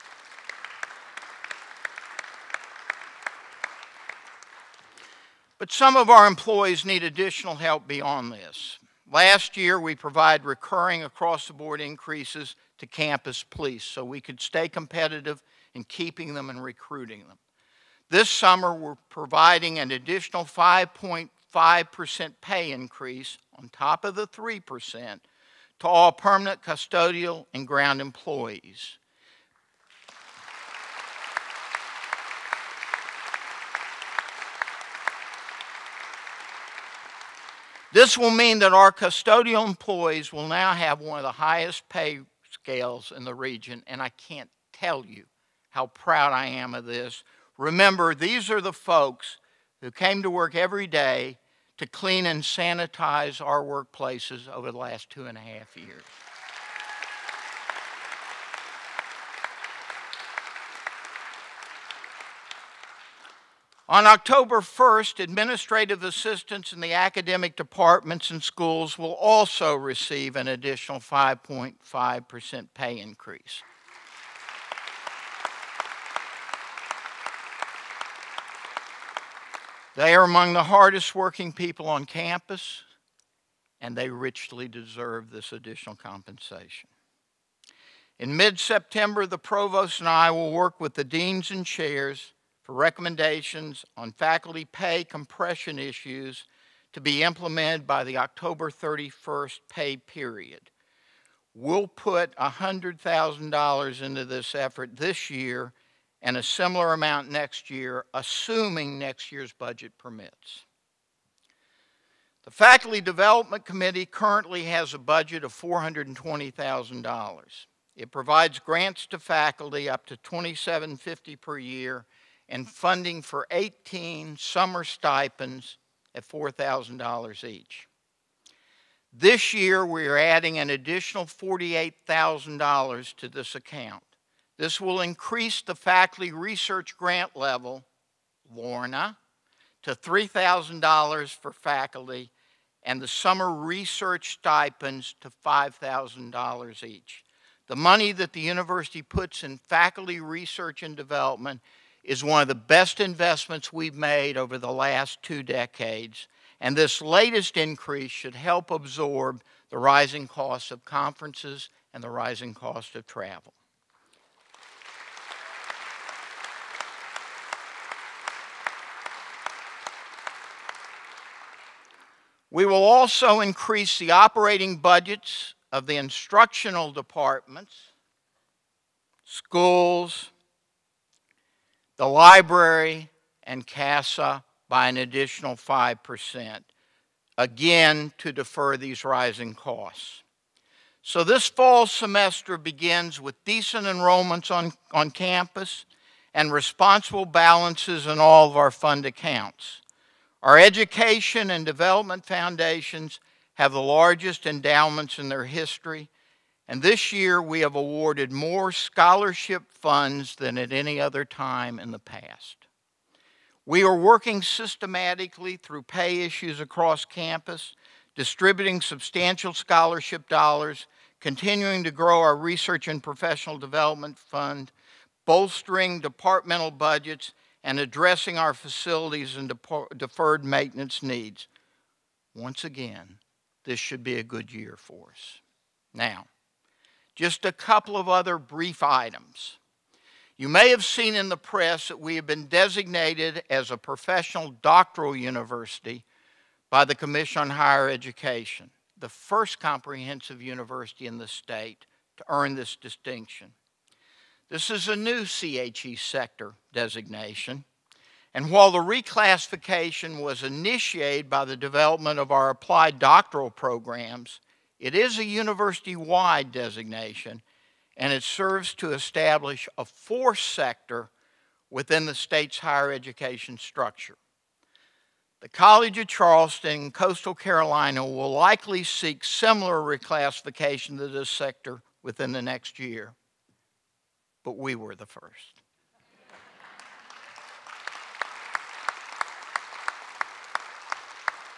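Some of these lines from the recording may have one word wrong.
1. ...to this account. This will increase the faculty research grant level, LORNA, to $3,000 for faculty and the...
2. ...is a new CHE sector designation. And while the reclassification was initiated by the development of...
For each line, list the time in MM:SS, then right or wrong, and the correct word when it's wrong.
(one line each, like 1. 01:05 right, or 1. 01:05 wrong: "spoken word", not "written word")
1. 02:13 right
2. 04:14 right.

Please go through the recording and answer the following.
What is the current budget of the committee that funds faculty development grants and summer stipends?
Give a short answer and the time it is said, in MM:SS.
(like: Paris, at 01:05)
$420,000, at 01:55.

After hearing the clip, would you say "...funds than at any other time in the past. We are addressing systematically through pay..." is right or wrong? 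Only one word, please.
wrong.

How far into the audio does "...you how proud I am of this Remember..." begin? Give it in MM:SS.
00:45.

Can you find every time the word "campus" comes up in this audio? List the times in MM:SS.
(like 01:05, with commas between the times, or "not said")
00:12, 01:22, 03:15, 03:37.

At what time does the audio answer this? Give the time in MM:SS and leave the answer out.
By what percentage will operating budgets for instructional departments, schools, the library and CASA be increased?
03:05.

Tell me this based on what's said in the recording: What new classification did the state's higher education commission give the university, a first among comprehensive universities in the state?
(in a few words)
professional doctoral university.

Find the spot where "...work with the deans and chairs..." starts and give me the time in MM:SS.
01:30.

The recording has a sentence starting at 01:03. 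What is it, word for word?
On October 1st, administrative assistants in the academic departments and schools will also receive an additional 5.5% pay increase.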